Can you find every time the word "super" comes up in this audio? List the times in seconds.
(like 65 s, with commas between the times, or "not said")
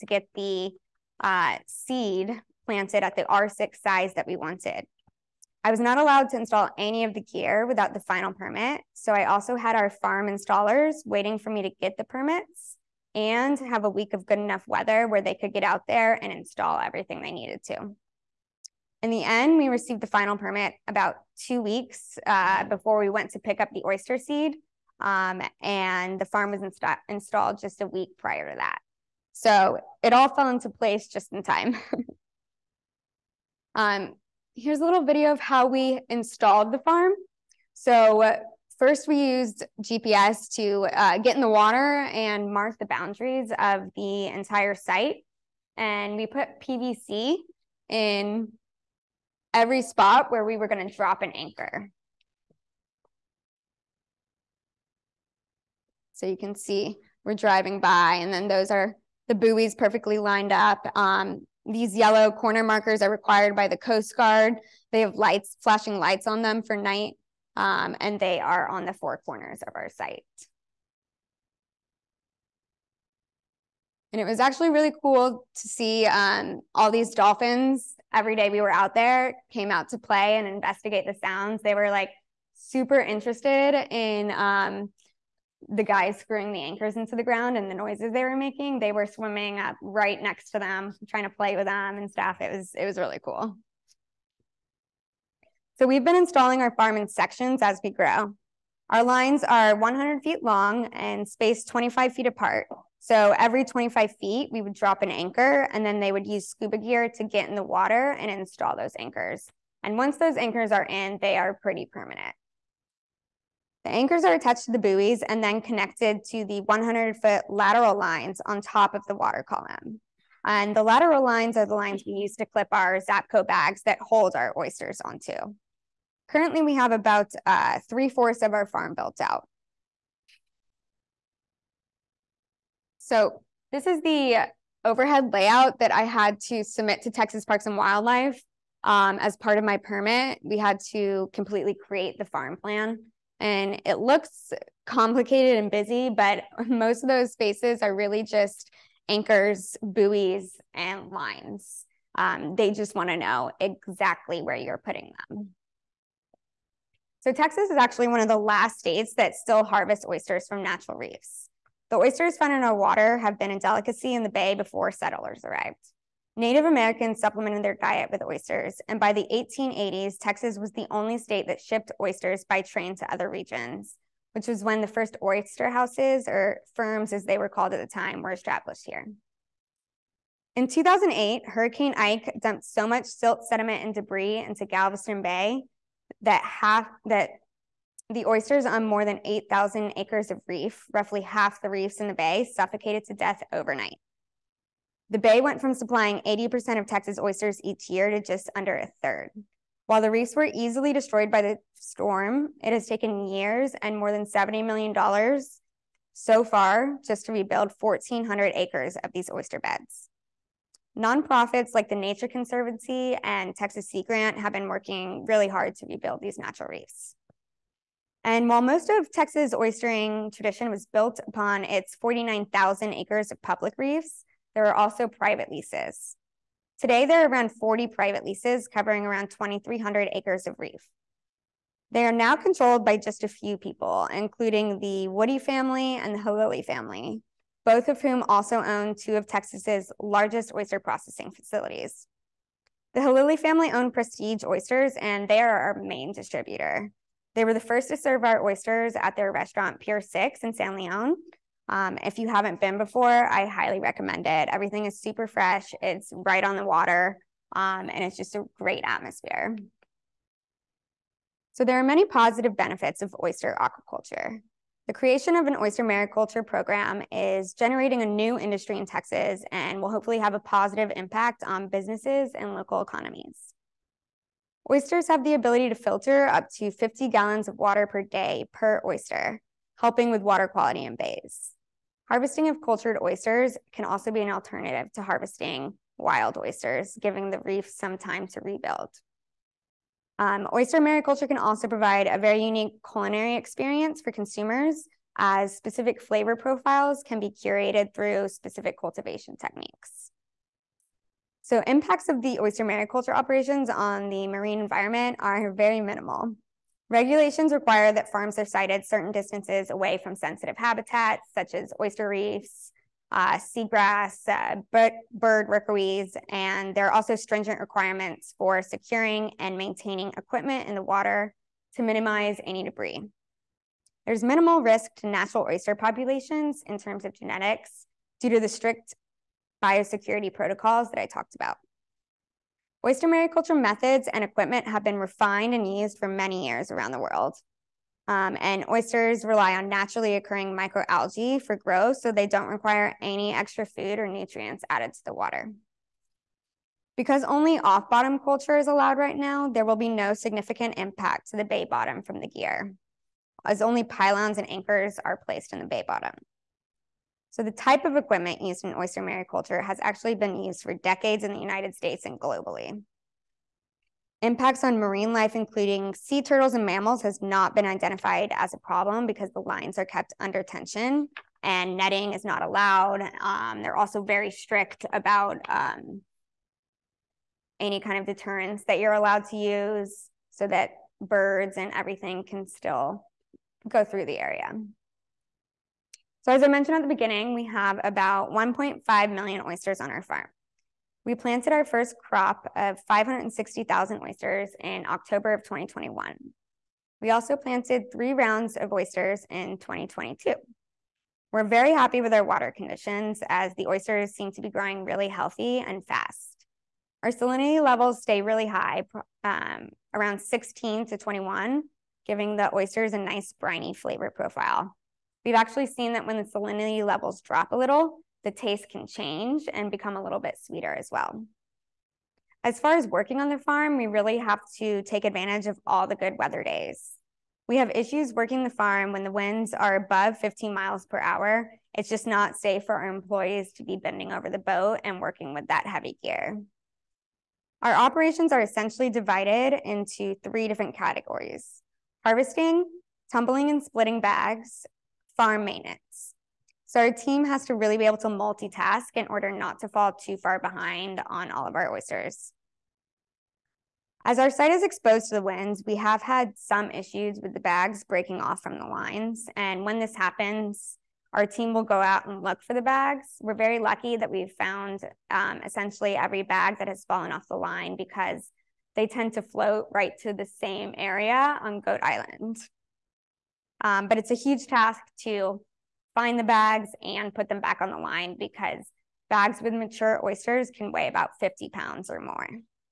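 82 s, 255 s.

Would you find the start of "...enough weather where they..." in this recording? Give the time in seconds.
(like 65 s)
14 s.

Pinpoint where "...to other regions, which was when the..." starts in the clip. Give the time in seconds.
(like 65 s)
172 s.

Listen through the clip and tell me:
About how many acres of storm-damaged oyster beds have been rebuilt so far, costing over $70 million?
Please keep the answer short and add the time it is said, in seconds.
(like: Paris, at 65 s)
1,400 acres, at 207 s.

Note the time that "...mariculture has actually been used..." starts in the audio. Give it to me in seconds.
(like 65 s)
359 s.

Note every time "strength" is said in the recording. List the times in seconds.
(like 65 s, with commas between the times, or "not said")
not said.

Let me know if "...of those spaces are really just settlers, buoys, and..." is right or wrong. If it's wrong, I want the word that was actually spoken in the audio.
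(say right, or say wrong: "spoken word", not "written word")
wrong: "anchors", not "settlers".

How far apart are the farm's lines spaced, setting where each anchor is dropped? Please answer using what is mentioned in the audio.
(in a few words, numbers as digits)
25 feet.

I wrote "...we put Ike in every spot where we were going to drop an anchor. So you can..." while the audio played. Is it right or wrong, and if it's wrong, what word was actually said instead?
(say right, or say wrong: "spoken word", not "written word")
wrong: "PVC", not "Ike".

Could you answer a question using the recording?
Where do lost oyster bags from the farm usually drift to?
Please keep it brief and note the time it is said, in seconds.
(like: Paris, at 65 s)
Goat Island, at 471 s.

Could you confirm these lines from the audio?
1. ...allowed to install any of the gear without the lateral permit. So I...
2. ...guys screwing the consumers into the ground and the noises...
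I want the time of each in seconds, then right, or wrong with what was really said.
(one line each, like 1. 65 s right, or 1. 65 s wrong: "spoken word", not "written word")
1. 5 s wrong: "final", not "lateral"
2. 85 s wrong: "anchors", not "consumers".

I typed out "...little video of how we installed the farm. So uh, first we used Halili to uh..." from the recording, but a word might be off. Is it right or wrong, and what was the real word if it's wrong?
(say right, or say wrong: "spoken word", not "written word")
wrong: "GPS", not "Halili".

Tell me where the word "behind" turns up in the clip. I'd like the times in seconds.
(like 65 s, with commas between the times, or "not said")
450 s.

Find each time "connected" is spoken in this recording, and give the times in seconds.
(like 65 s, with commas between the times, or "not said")
115 s.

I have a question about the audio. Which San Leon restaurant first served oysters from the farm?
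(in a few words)
Pier 6.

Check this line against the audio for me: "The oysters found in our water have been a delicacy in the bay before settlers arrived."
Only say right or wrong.
right.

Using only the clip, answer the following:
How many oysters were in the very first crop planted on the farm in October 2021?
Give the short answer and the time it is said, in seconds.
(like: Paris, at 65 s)
560,000, at 392 s.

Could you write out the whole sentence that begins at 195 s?
The bay went from supplying 80% of Texas oysters each year to just under a third.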